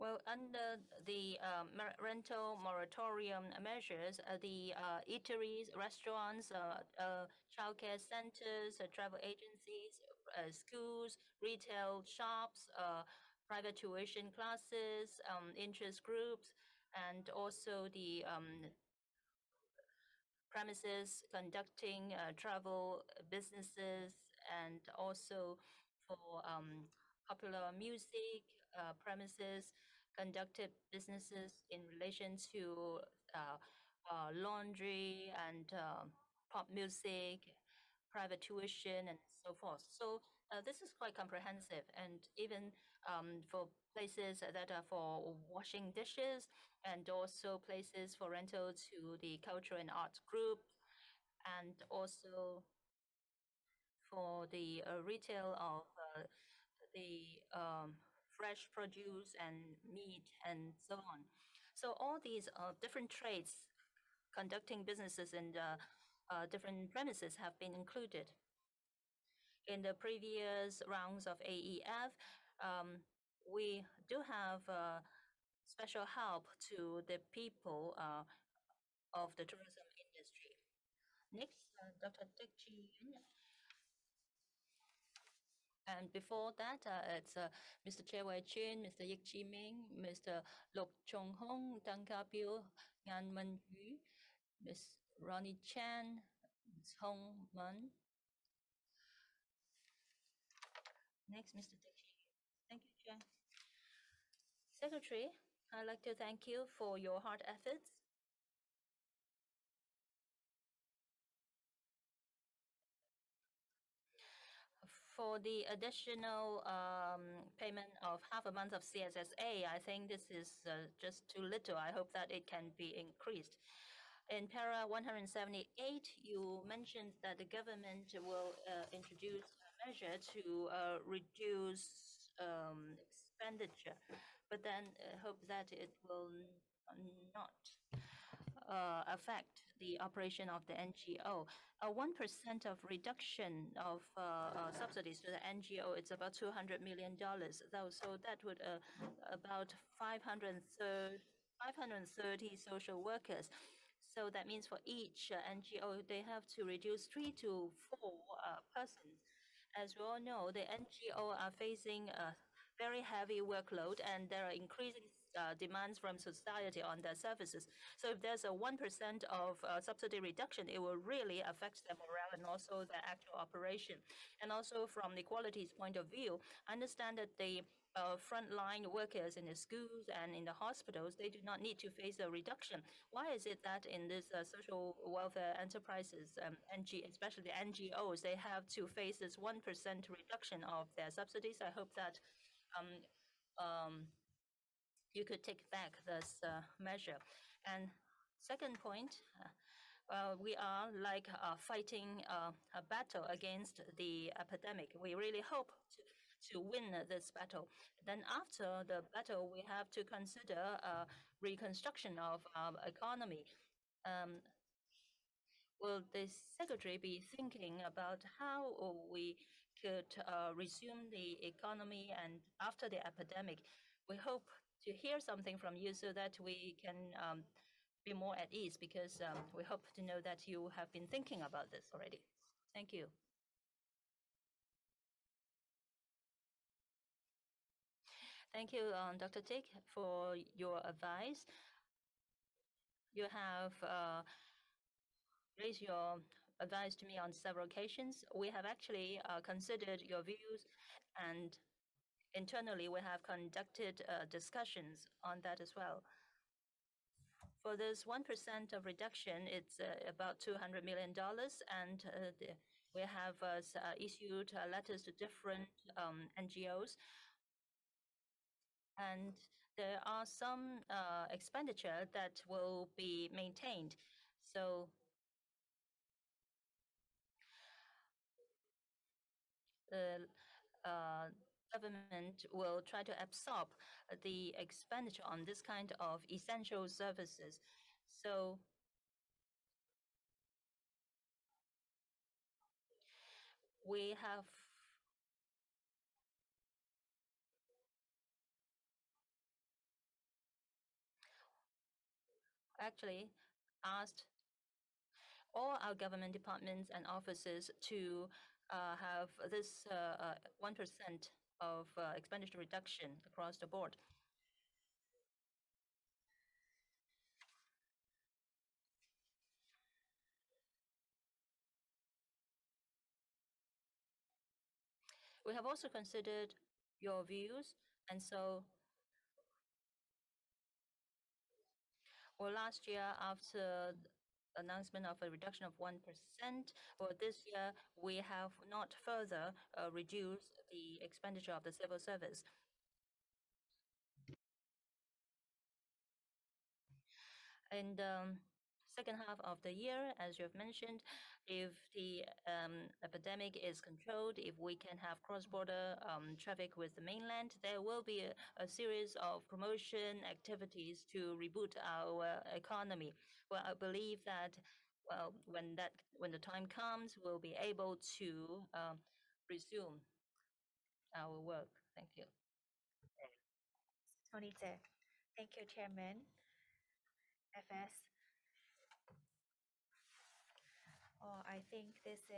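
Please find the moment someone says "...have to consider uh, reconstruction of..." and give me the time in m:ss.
3:29.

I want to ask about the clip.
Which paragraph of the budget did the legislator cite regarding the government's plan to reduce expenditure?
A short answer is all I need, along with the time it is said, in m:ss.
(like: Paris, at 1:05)
178, at 2:04.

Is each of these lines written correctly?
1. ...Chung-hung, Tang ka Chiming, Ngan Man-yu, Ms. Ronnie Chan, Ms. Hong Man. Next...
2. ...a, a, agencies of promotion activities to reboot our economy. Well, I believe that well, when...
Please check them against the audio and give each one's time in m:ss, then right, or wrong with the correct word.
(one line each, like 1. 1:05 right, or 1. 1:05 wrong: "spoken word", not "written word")
1. 1:31 wrong: "Piu", not "Chiming"
2. 5:58 wrong: "series", not "agencies".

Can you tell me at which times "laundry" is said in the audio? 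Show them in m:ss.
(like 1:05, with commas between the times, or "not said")
0:34.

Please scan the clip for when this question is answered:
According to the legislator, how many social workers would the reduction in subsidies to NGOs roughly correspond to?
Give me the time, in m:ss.
2:29.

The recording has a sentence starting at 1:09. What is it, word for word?
In the previous rounds of AEF, um, we do have uh, special help to the people uh, of the tourism industry.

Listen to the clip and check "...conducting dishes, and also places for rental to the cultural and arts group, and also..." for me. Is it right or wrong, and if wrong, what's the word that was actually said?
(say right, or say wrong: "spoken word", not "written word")
wrong: "washing", not "conducting".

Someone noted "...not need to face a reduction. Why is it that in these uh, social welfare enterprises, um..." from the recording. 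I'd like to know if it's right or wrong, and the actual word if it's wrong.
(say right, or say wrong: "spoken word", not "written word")
right.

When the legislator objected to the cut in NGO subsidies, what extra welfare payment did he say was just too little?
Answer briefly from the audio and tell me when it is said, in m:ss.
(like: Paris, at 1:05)
half a month of CSSA, at 1:58.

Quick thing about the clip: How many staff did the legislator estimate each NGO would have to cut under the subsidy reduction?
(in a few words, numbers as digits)
3 to 4.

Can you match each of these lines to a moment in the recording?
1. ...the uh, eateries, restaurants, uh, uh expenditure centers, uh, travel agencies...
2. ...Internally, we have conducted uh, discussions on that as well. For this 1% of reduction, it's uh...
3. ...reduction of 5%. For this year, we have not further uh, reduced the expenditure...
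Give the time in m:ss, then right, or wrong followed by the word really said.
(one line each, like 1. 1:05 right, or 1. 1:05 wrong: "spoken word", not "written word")
1. 0:04 wrong: "childcare", not "expenditure"
2. 4:12 right
3. 5:35 wrong: "1", not "5".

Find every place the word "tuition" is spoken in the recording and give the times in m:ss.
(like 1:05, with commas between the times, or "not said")
0:13, 0:38.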